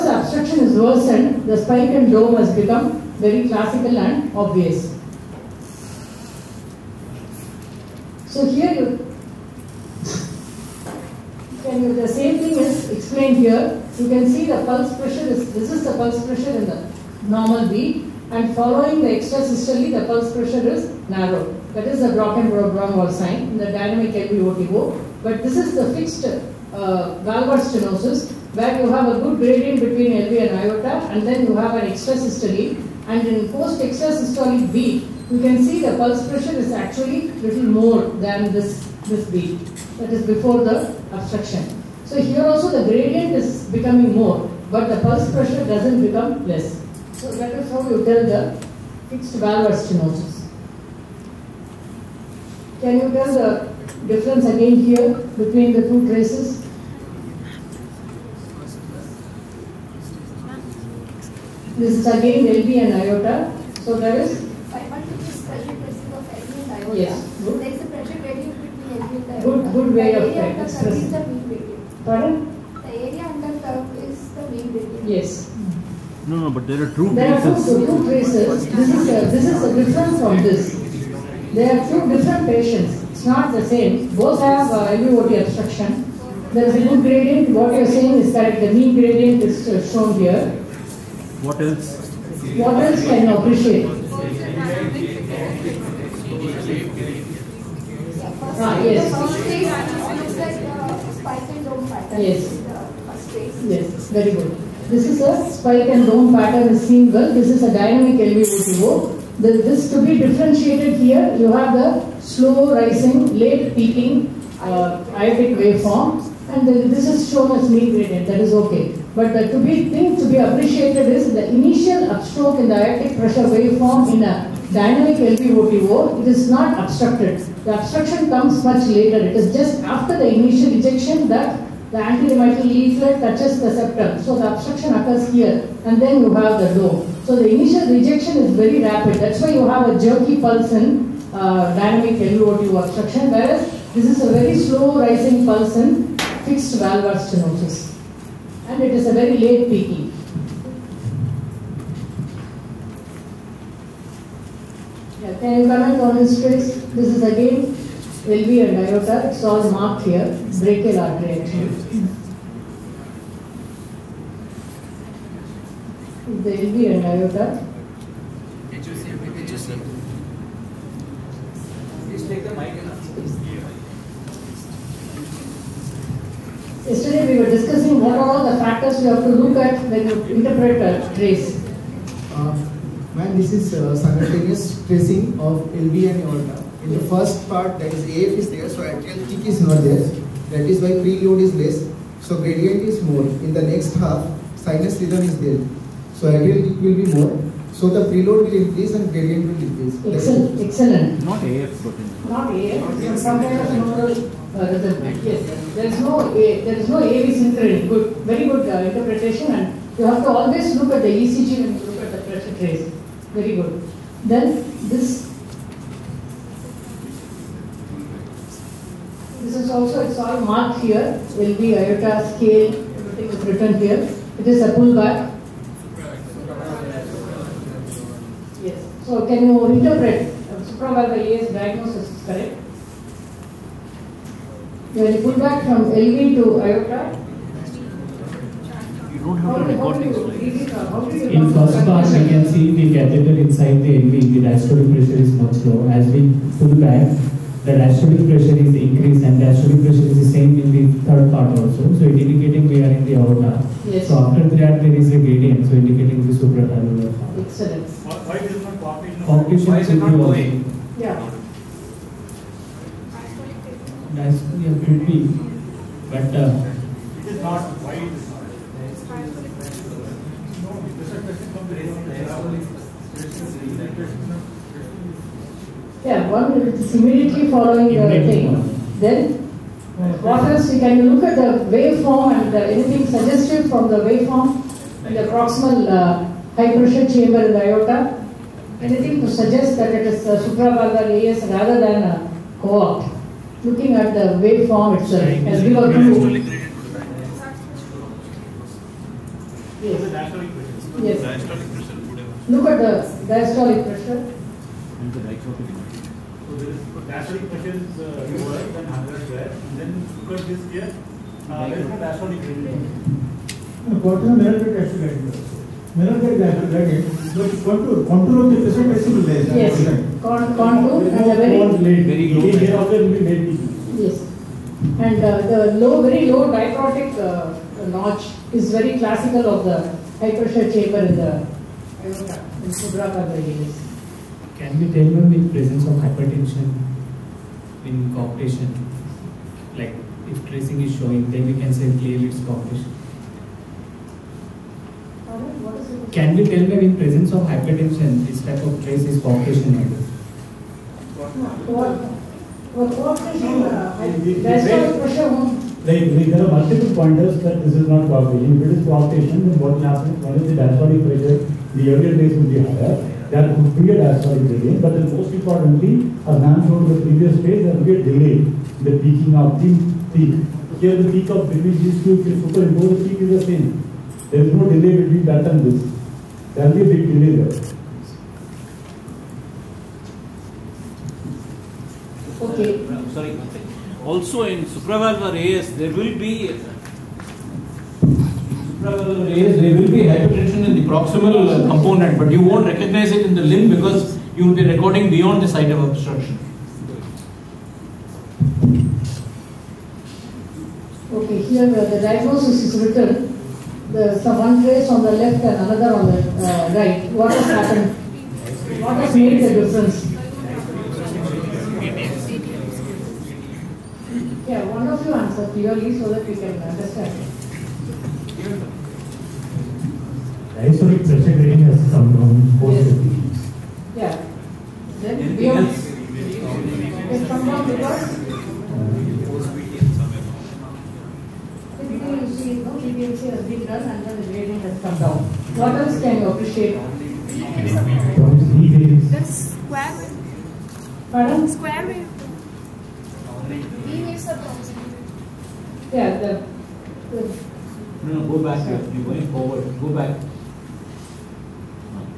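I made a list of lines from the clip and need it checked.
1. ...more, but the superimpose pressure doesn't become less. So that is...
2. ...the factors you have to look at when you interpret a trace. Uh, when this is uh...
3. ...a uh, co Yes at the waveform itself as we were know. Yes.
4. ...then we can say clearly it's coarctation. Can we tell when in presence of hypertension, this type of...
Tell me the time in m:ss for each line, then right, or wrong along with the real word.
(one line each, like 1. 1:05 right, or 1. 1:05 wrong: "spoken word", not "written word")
1. 0:44 wrong: "pulse", not "superimpose"
2. 2:58 right
3. 4:52 wrong: "Looking", not "Yes"
4. 5:41 right.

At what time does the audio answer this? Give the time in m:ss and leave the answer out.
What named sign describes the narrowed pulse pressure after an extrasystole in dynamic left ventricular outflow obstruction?
0:22.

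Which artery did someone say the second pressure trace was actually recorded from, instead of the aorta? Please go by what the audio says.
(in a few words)
Brachial artery.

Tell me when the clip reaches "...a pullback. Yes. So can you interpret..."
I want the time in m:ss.
3:44.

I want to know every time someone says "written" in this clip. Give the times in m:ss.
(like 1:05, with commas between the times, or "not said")
3:43, 6:42.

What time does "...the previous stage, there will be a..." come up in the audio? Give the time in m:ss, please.
6:06.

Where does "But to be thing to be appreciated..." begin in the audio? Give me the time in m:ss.
1:59.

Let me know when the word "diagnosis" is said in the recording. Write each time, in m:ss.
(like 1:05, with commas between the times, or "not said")
3:51, 6:42.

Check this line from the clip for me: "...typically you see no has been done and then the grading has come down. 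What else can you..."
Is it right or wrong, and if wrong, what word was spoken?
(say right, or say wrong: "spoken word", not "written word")
right.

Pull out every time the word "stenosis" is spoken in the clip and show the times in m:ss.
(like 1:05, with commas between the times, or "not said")
0:27, 0:49, 2:27.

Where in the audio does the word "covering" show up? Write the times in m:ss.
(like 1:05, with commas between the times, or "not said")
not said.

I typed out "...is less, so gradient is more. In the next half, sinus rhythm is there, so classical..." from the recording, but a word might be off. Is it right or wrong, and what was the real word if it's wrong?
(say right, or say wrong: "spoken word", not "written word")
wrong: "atrial", not "classical".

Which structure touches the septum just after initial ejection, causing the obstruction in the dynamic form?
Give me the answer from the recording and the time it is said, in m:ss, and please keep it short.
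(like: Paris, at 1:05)
Anterior mitral leaflet, at 2:11.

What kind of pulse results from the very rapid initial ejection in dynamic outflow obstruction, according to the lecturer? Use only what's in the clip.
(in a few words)
Jerky pulse.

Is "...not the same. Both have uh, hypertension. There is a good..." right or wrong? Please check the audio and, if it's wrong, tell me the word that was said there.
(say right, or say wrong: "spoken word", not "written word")
wrong: "obstruction", not "hypertension".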